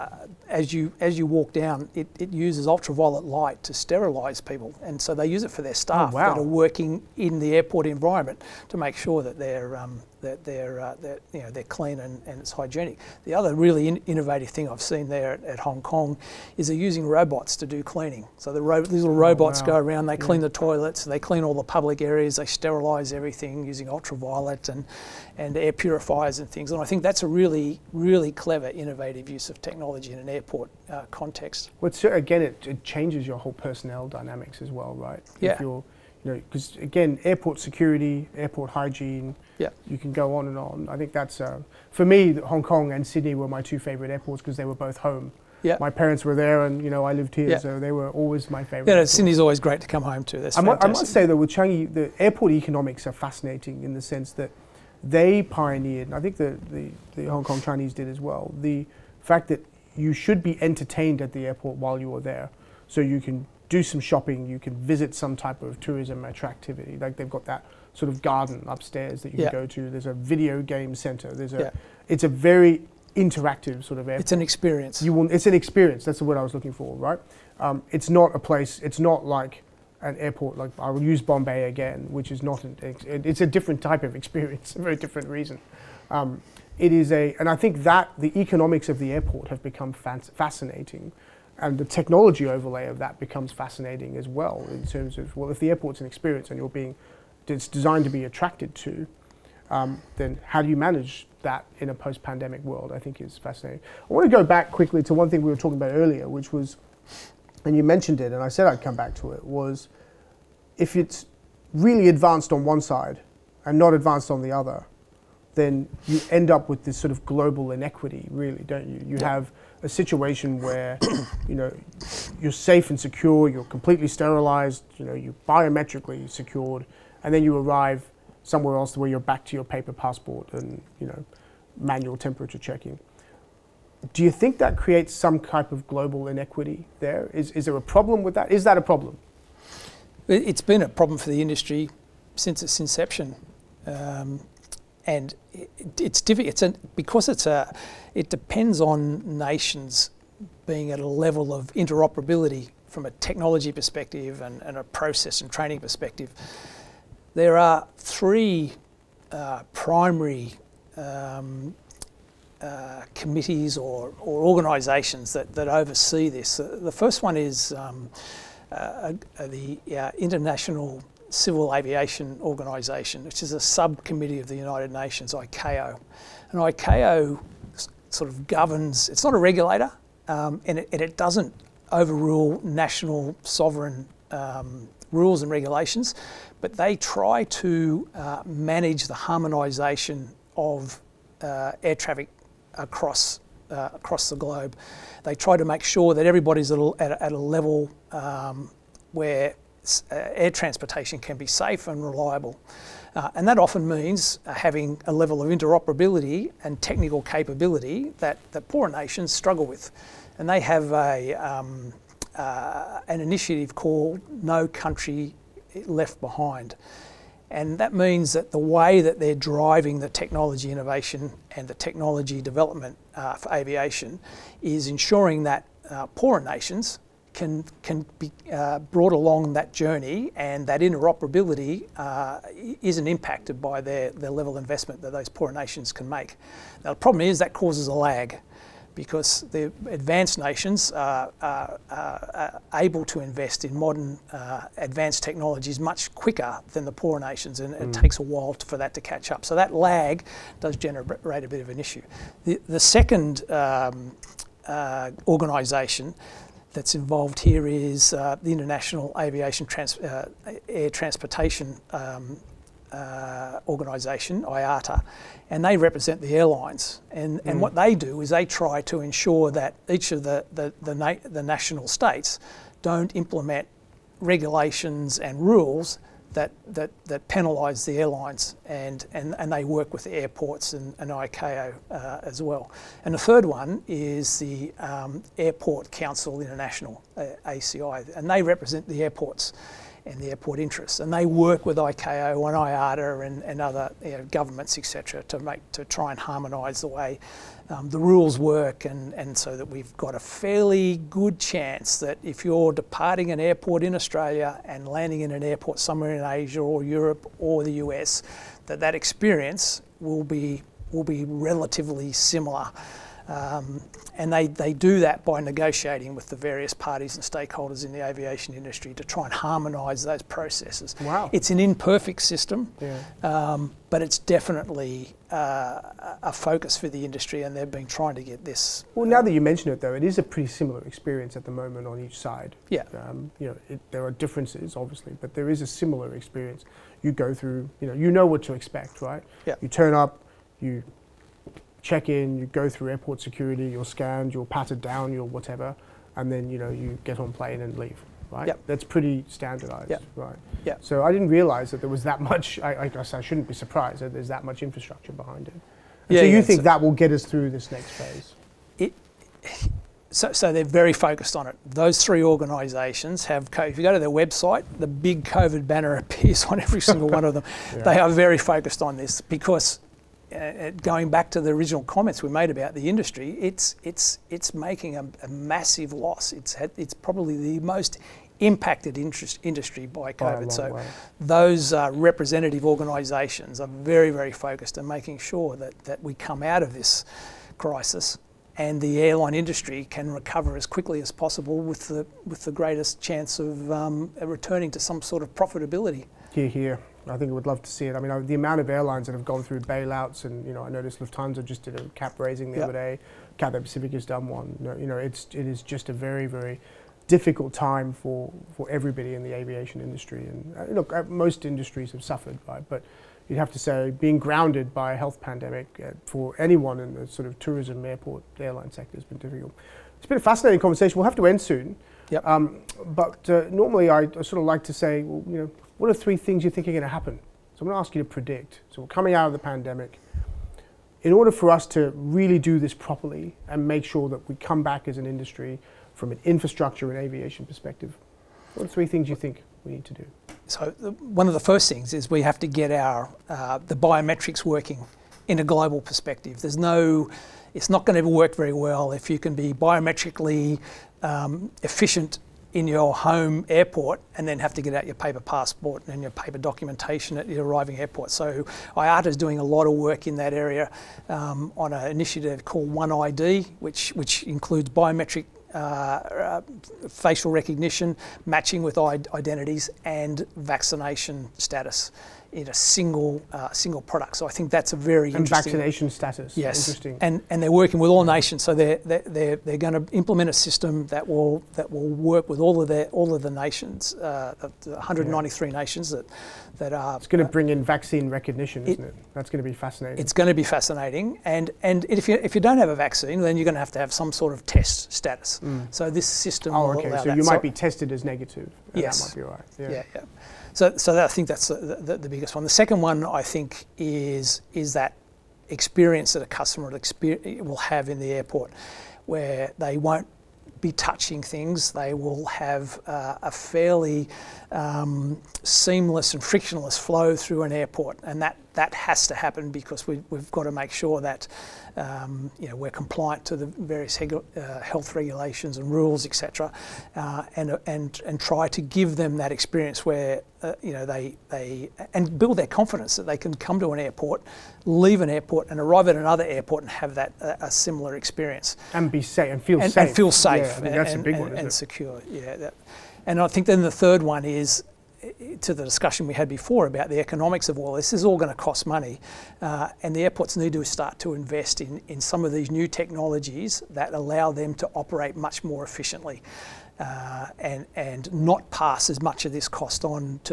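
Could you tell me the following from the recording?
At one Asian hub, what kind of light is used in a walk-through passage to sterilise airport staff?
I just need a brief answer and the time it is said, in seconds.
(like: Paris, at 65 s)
Ultraviolet light, at 2 s.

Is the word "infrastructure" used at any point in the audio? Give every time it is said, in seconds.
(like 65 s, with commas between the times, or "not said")
354 s, 436 s.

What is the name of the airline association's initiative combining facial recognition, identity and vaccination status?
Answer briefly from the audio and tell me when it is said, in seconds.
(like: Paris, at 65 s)
One ID, at 462 s.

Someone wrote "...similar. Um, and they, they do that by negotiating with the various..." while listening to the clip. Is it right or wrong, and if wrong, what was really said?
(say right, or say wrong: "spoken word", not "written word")
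right.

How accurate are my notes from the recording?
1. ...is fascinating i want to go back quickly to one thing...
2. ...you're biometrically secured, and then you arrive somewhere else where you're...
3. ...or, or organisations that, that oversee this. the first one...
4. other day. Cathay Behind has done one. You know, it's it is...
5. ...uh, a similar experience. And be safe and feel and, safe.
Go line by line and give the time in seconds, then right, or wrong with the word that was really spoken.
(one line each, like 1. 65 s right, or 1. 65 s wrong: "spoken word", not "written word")
1. 103 s right
2. 125 s right
3. 163 s right
4. 402 s wrong: "Pacific", not "Behind"
5. 537 s right.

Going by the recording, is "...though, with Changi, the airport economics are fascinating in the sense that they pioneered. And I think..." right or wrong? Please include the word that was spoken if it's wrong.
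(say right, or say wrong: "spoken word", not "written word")
right.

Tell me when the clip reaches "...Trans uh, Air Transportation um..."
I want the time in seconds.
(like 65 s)
259 s.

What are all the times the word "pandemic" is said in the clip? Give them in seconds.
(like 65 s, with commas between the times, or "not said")
101 s, 415 s, 429 s.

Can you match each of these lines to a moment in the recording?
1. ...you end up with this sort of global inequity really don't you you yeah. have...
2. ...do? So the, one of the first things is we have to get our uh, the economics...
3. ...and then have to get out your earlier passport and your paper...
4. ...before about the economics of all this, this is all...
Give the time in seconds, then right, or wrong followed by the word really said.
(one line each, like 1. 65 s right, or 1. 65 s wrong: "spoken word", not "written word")
1. 116 s right
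2. 439 s wrong: "biometrics", not "economics"
3. 454 s wrong: "paper", not "earlier"
4. 546 s right.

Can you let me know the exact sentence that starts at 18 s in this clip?
So the ro these little oh, robots oh, wow.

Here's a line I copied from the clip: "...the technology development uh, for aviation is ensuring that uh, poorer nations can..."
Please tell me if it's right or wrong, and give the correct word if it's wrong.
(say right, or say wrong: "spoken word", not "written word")
right.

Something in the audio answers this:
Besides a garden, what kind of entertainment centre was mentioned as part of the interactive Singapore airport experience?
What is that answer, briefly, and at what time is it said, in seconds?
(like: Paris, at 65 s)
Video game center, at 70 s.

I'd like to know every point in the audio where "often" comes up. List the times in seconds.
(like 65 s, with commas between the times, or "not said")
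203 s.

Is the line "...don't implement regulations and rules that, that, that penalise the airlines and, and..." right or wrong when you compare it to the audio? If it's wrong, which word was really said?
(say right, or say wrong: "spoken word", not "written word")
right.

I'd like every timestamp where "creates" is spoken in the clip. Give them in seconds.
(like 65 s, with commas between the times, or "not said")
134 s.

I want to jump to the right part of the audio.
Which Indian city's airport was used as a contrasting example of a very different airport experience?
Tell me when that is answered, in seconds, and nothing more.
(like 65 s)
81 s.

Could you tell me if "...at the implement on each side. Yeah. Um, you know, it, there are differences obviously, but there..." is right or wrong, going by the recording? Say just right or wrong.
wrong.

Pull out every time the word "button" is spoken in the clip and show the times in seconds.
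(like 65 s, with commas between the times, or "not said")
not said.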